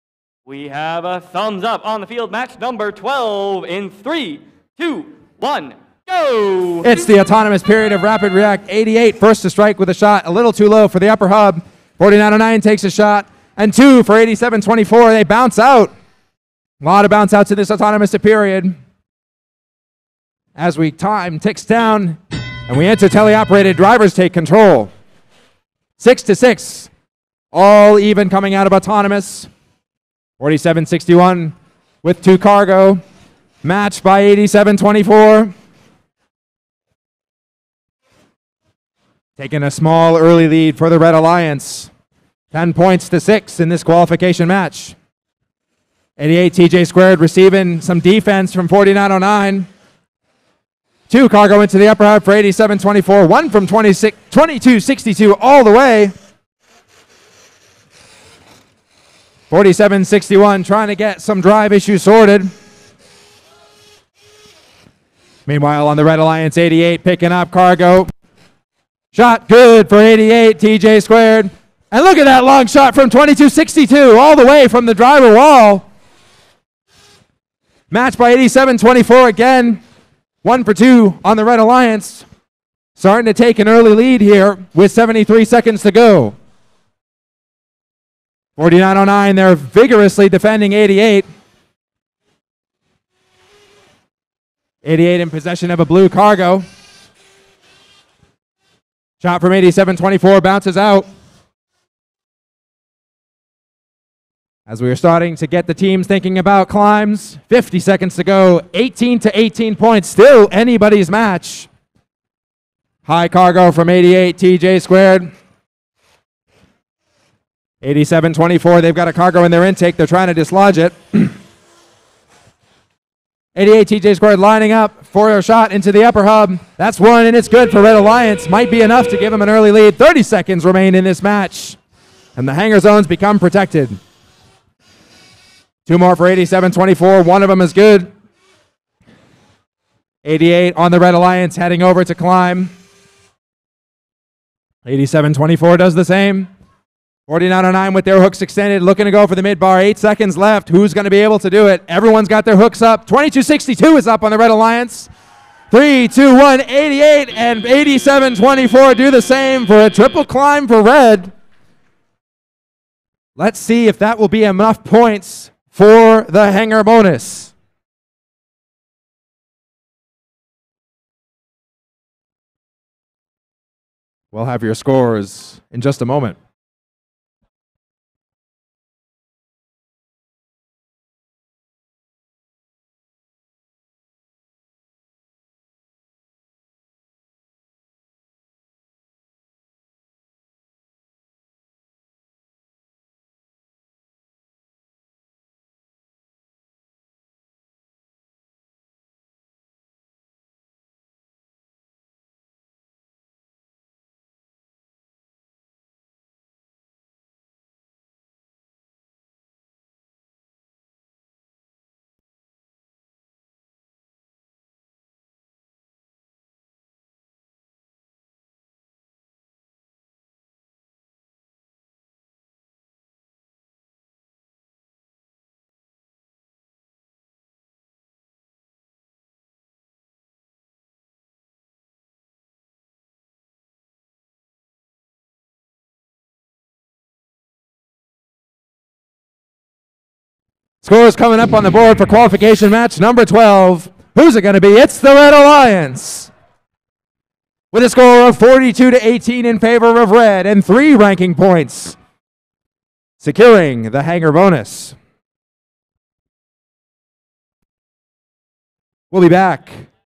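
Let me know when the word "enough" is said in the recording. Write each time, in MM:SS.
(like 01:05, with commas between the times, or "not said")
02:08, 02:44.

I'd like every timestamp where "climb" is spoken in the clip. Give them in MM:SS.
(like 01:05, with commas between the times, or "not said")
01:46, 02:22, 02:40.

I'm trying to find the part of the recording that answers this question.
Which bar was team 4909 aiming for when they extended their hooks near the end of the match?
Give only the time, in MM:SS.
02:29.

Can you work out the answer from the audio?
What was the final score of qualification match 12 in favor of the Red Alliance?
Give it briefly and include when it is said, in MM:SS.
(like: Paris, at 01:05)
42 to 18, at 04:08.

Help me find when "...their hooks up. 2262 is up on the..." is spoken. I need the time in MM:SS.
02:32.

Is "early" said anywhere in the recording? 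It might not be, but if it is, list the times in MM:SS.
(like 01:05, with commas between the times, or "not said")
00:40, 01:23, 02:09.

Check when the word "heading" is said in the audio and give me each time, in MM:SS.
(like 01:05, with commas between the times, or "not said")
02:21.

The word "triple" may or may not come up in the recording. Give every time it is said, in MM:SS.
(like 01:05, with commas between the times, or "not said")
02:39.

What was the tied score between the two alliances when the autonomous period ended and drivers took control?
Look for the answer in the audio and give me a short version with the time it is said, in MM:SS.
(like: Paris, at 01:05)
6 to 6, at 00:25.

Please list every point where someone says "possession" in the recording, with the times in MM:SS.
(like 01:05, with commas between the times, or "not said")
01:35.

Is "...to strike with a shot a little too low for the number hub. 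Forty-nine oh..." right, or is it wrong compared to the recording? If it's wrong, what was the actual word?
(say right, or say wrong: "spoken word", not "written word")
wrong: "upper", not "number".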